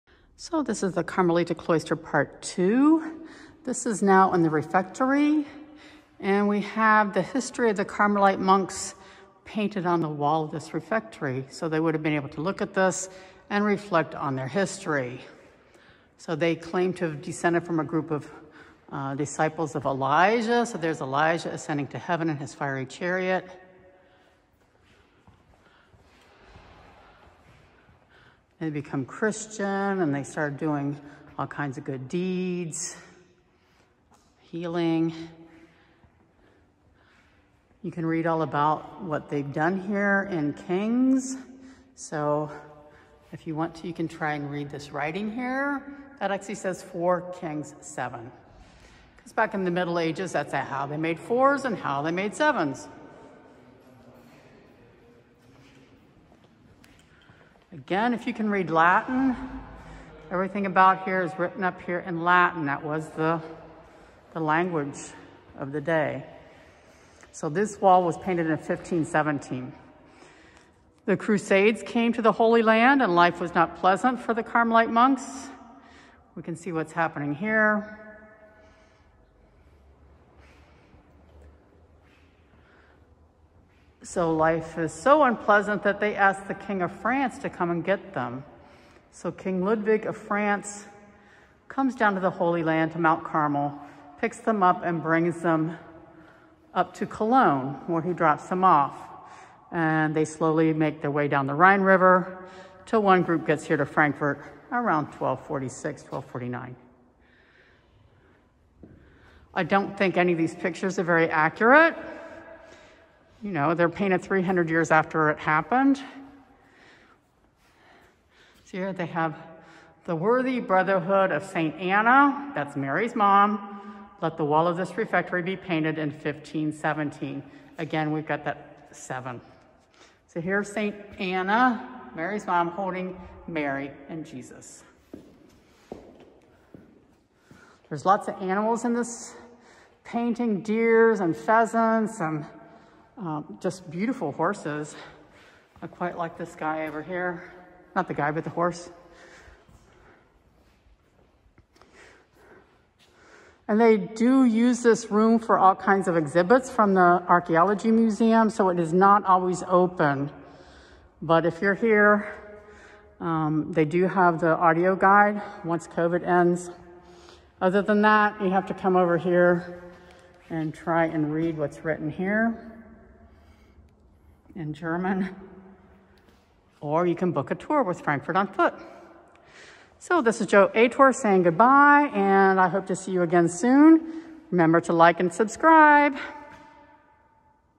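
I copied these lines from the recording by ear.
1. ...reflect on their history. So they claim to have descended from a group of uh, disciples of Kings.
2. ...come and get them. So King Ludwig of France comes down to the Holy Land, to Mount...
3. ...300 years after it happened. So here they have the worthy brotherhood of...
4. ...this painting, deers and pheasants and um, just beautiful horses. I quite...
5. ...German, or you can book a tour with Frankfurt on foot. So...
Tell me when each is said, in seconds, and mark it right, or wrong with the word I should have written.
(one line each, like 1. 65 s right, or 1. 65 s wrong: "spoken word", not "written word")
1. 13 s wrong: "Elijah", not "Kings"
2. 87 s right
3. 114 s right
4. 138 s right
5. 174 s right.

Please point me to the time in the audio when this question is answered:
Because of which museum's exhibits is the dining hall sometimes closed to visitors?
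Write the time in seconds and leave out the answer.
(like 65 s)
157 s.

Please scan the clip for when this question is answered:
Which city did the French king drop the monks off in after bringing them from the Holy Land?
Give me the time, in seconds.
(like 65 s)
97 s.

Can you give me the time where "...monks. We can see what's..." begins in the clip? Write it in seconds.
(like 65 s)
74 s.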